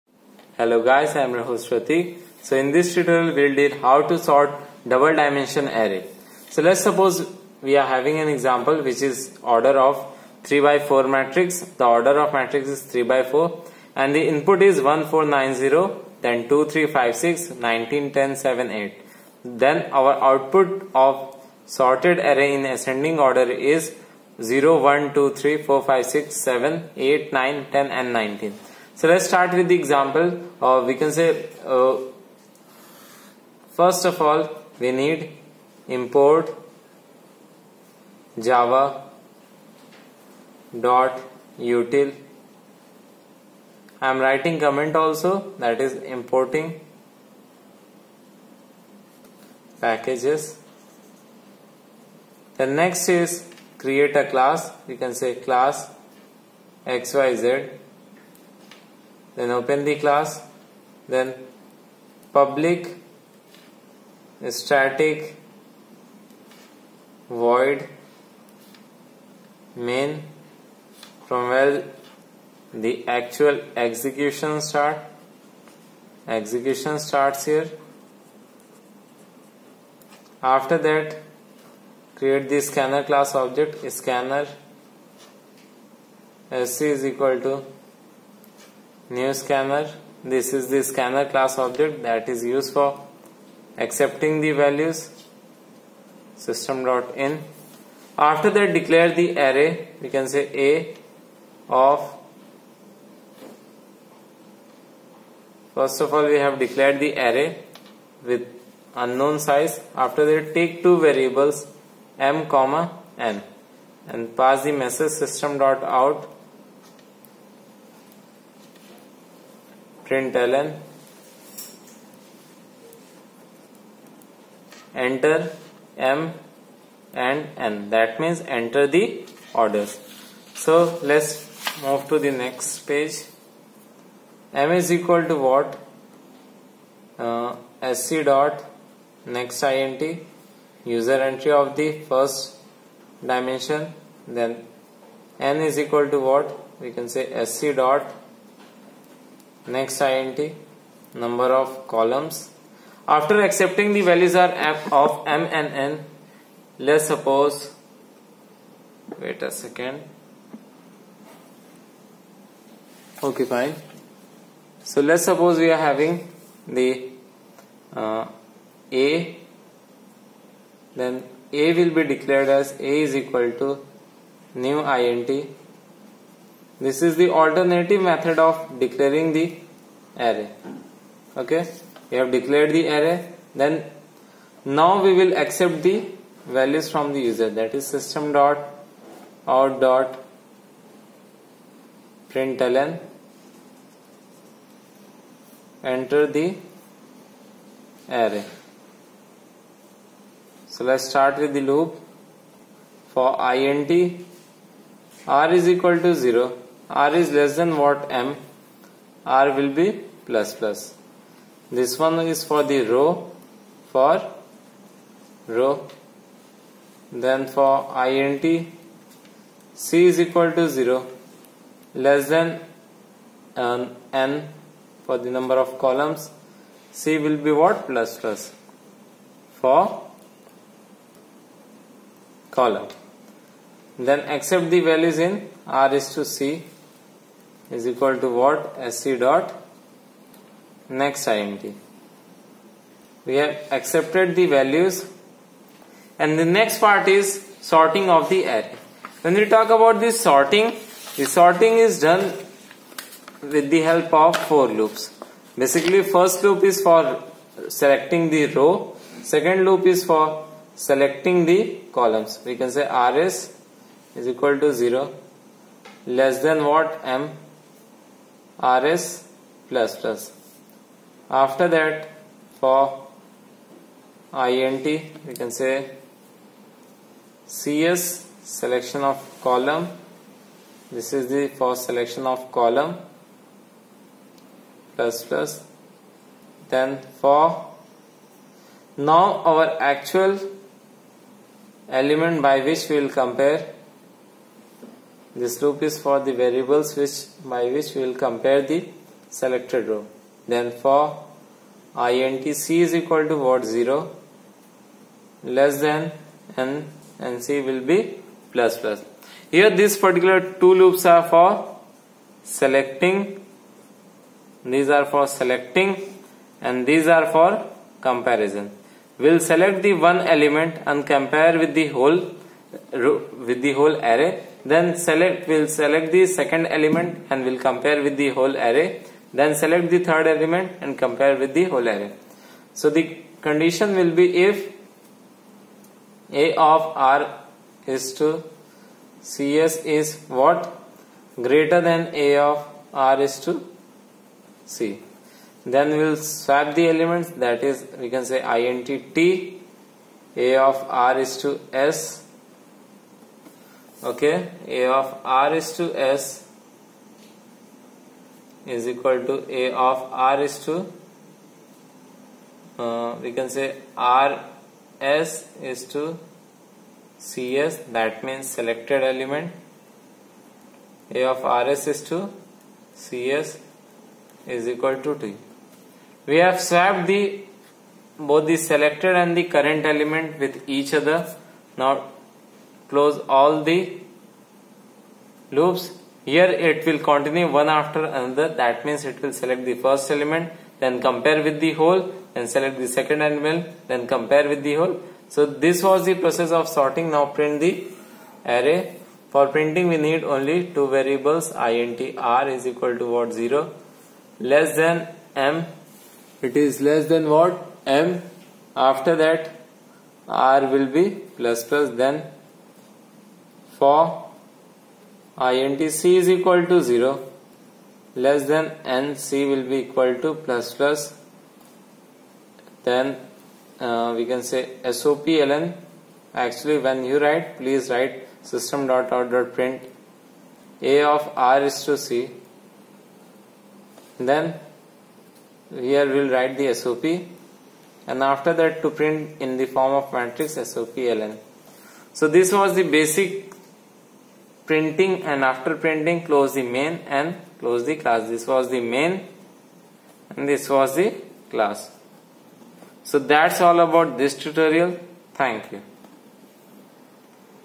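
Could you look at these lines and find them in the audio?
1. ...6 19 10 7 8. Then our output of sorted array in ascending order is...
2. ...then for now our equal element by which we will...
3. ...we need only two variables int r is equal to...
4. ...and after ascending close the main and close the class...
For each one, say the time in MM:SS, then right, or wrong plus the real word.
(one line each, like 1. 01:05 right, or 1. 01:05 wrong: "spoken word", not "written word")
1. 00:17 right
2. 04:46 wrong: "actual", not "equal"
3. 06:39 right
4. 07:25 wrong: "printing", not "ascending".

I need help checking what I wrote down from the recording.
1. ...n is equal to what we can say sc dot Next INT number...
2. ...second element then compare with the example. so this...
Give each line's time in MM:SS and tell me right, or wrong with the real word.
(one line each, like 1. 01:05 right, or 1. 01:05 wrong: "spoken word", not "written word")
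1. 02:25 right
2. 06:32 wrong: "whole", not "example".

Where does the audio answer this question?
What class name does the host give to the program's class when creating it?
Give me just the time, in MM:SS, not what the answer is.
00:55.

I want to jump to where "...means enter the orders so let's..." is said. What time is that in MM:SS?
02:08.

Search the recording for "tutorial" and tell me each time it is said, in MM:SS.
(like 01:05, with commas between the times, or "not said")
00:02, 07:34.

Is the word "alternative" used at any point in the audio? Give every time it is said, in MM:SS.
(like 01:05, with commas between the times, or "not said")
02:57.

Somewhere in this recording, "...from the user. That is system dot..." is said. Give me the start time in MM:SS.
03:06.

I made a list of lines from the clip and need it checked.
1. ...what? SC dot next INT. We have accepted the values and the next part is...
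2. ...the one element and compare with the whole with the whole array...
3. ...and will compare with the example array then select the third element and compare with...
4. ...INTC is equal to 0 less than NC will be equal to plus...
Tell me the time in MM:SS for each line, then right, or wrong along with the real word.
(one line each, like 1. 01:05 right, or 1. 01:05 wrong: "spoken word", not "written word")
1. 03:58 right
2. 05:19 right
3. 05:27 wrong: "whole", not "example"
4. 06:55 right.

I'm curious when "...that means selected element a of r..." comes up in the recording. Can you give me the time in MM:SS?
06:07.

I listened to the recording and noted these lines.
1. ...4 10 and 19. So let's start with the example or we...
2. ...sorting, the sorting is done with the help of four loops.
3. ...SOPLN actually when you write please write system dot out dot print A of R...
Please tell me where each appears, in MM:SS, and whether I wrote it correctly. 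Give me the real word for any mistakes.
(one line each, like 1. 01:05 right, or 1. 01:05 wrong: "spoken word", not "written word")
1. 00:27 wrong: "9", not "4"
2. 04:10 right
3. 07:04 right.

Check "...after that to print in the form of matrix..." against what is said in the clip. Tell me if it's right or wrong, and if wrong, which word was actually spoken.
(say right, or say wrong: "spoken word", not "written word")
right.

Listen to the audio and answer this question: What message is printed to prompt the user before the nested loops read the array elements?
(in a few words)
Enter the array.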